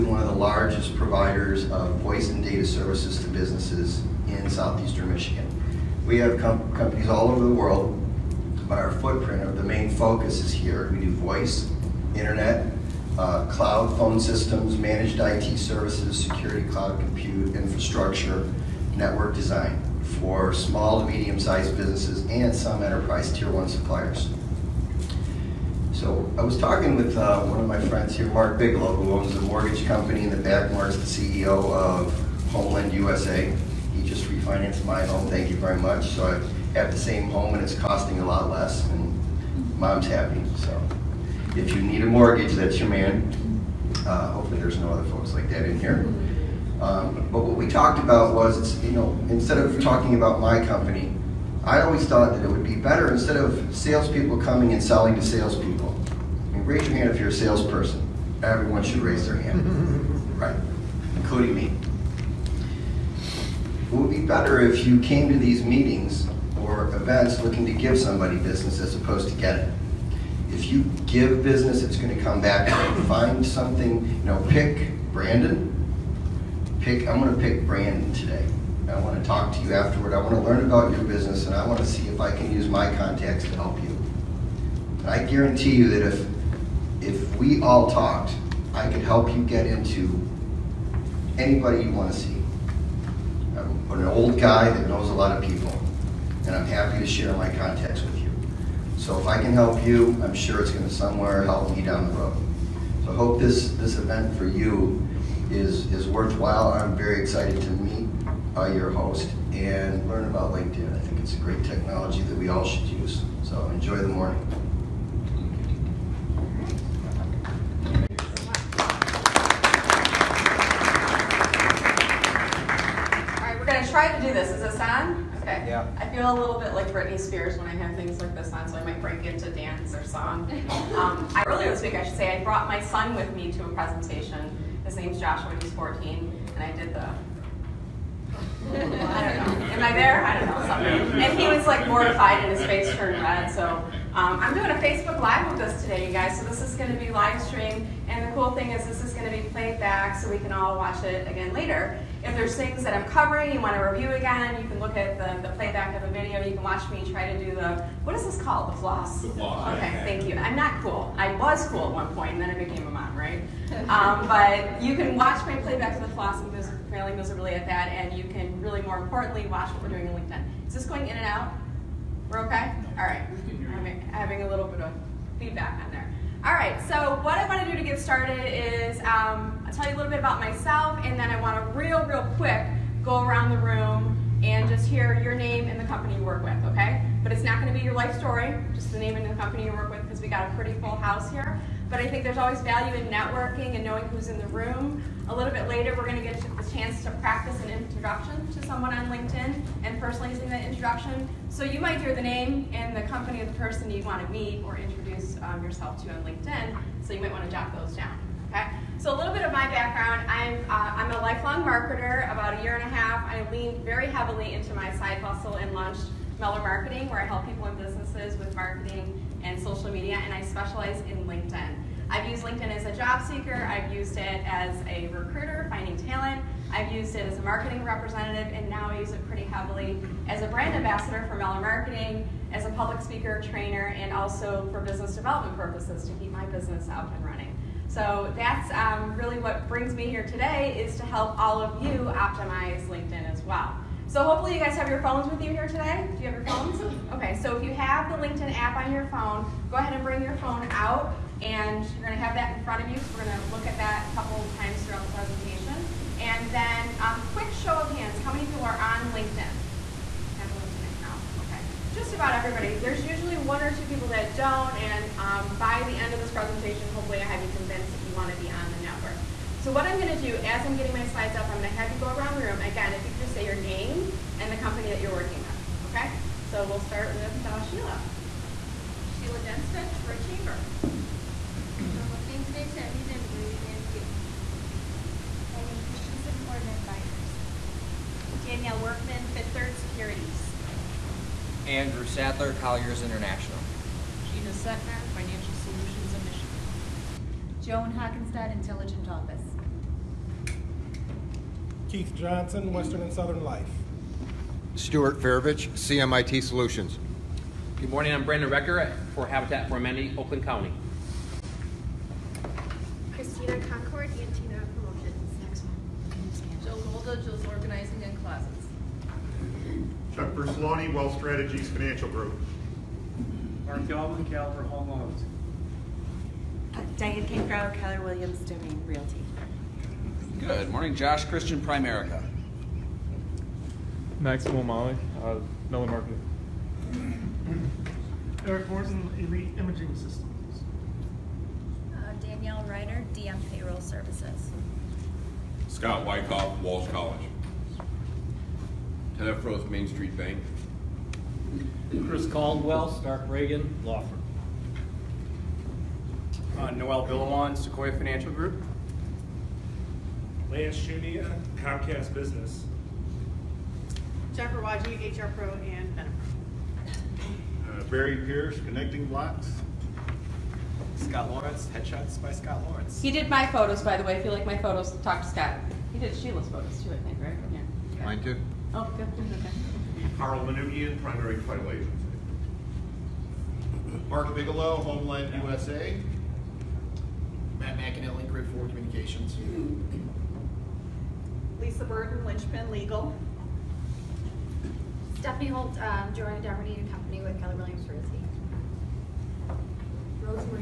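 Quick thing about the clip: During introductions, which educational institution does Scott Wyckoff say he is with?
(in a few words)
Walsh College.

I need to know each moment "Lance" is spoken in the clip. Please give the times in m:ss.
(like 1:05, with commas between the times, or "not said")
6:00.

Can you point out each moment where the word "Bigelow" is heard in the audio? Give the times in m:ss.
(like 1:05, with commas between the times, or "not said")
0:28, 6:24.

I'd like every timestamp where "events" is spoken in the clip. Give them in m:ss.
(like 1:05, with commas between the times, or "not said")
1:06, 1:43.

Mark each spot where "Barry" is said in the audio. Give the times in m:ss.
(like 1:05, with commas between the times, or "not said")
6:07.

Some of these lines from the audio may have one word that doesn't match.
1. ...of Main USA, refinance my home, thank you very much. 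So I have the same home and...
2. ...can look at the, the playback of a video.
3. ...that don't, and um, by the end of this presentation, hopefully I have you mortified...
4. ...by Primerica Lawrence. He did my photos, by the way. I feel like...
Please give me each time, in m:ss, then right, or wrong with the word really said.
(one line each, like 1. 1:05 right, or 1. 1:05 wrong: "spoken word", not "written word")
1. 0:31 wrong: "Homeland", not "Main"
2. 2:34 right
3. 4:24 wrong: "convinced", not "mortified"
4. 6:12 wrong: "Scott", not "Primerica".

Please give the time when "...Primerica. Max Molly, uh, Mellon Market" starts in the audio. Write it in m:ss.
5:31.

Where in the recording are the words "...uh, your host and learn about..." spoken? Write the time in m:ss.
1:48.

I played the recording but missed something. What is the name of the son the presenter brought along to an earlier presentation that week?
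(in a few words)
Joshua.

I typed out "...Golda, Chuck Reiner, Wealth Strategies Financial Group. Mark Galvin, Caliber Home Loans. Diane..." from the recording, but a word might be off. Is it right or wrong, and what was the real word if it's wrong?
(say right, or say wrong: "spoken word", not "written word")
wrong: "Bertoloni", not "Reiner".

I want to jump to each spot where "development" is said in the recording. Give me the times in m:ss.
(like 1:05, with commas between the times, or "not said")
3:55.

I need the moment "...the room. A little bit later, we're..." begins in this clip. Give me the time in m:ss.
3:14.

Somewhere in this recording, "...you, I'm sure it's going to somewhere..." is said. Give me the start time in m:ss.
1:39.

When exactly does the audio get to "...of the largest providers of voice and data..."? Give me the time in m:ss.
0:00.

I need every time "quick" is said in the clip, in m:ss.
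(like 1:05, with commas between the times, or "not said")
3:02, 4:17.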